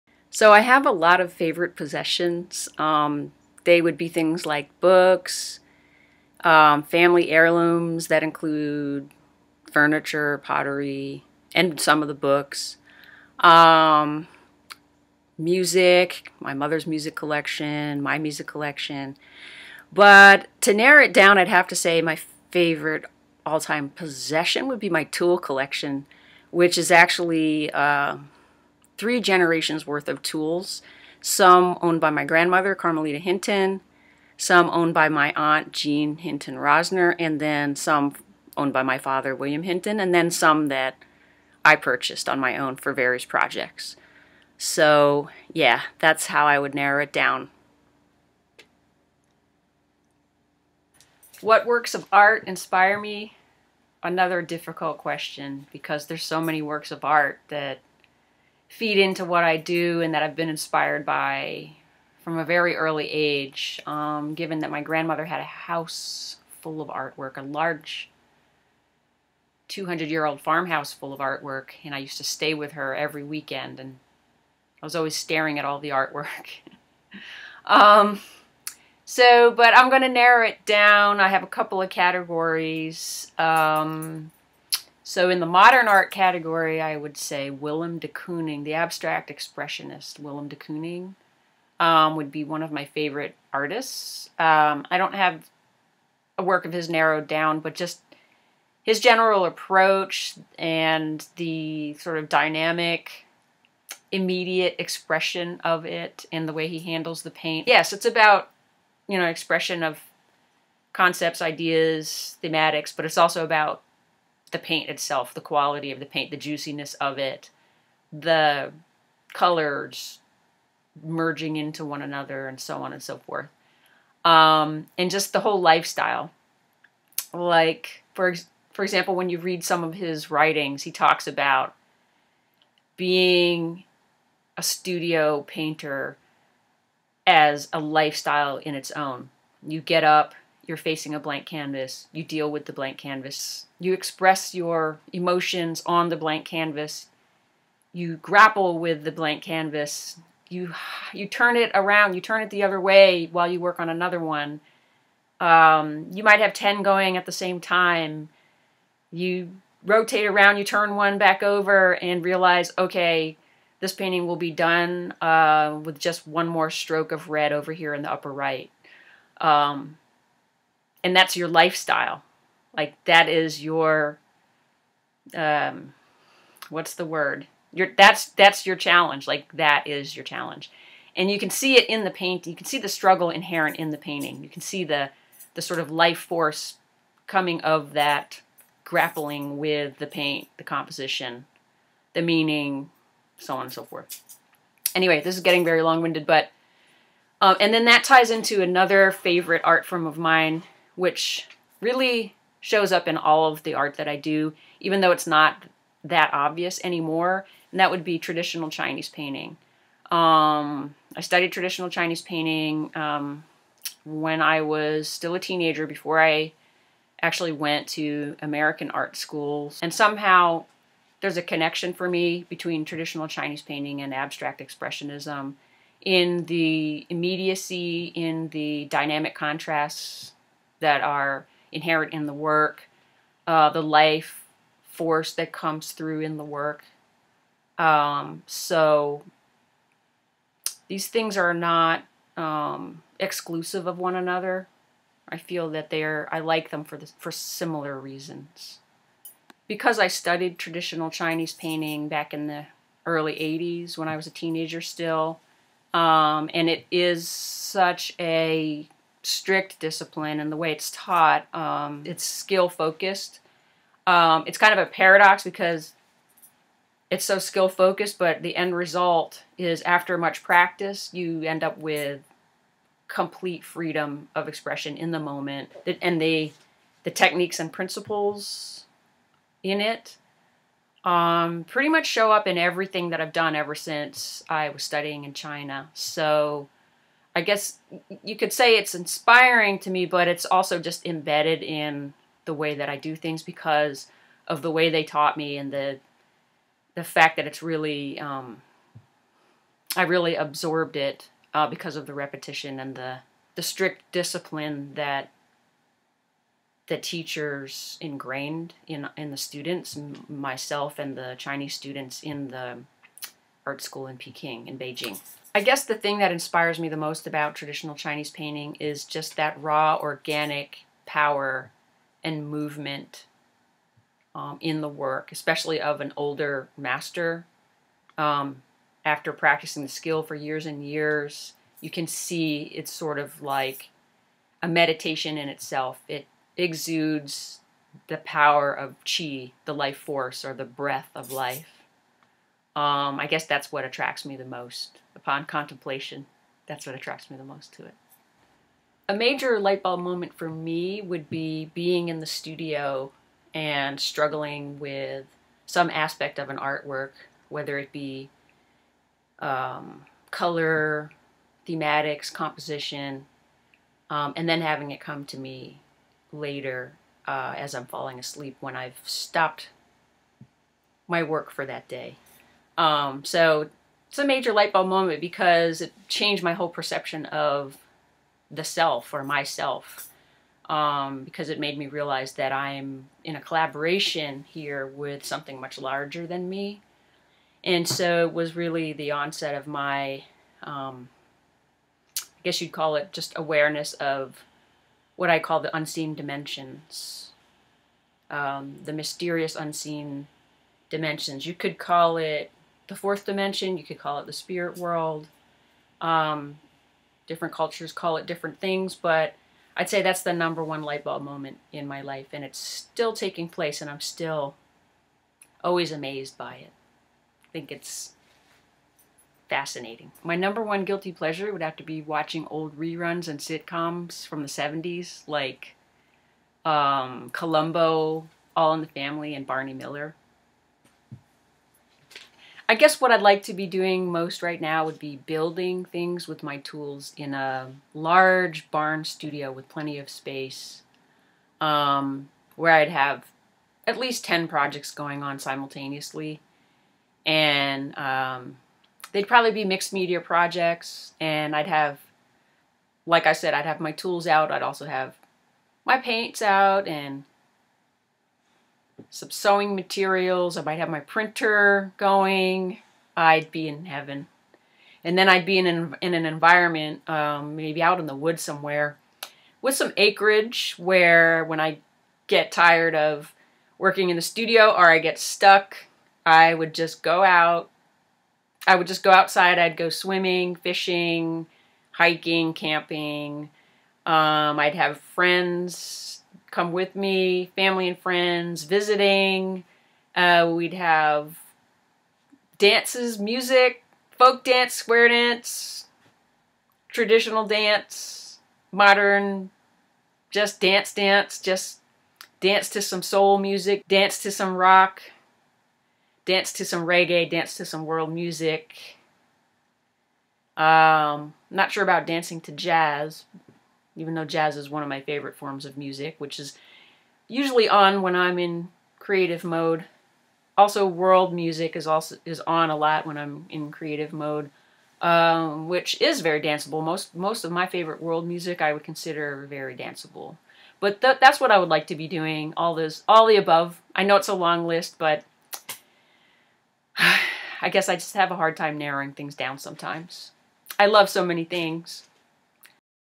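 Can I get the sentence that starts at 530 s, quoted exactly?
But th that's what I would like to be doing.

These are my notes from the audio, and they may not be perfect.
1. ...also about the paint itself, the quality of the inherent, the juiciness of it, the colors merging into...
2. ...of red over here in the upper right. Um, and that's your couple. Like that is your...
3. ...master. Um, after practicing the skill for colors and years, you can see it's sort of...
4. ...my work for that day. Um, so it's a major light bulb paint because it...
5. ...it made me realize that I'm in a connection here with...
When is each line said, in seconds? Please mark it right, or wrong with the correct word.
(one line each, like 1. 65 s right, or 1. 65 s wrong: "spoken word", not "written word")
1. 113 s wrong: "paint", not "inherent"
2. 167 s wrong: "lifestyle", not "couple"
3. 326 s wrong: "years", not "colors"
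4. 371 s wrong: "moment", not "paint"
5. 381 s wrong: "collaboration", not "connection".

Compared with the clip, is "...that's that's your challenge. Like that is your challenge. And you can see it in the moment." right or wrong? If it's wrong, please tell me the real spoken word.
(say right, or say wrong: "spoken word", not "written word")
wrong: "paint", not "moment".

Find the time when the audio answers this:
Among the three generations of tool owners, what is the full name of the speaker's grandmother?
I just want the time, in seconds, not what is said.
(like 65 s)
32 s.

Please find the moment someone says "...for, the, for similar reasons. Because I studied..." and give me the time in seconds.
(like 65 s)
246 s.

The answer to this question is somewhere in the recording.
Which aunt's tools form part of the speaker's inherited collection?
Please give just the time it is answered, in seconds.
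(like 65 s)
35 s.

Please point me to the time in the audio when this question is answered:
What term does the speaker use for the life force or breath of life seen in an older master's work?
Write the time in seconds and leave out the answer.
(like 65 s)
339 s.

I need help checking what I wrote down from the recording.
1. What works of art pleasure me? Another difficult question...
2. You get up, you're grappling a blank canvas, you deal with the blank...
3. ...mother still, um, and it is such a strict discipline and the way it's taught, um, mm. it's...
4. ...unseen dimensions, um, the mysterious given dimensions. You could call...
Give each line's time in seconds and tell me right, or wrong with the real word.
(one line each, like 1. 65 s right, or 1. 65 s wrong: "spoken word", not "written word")
1. 51 s wrong: "inspire", not "pleasure"
2. 139 s wrong: "facing", not "grappling"
3. 254 s wrong: "teenager", not "mother"
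4. 395 s wrong: "unseen", not "given".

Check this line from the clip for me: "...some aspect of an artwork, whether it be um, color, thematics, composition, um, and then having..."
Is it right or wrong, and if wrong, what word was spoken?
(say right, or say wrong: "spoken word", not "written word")
right.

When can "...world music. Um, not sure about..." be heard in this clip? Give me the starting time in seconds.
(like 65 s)
507 s.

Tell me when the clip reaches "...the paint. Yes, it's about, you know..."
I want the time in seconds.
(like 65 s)
107 s.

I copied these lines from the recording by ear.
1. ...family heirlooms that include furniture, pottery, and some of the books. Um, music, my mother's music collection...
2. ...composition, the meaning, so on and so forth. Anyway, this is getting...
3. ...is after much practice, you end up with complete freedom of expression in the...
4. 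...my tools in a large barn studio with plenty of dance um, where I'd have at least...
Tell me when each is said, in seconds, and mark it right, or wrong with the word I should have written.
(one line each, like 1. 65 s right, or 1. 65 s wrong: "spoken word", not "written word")
1. 6 s right
2. 190 s right
3. 269 s right
4. 436 s wrong: "space", not "dance".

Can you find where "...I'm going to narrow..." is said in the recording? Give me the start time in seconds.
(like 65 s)
79 s.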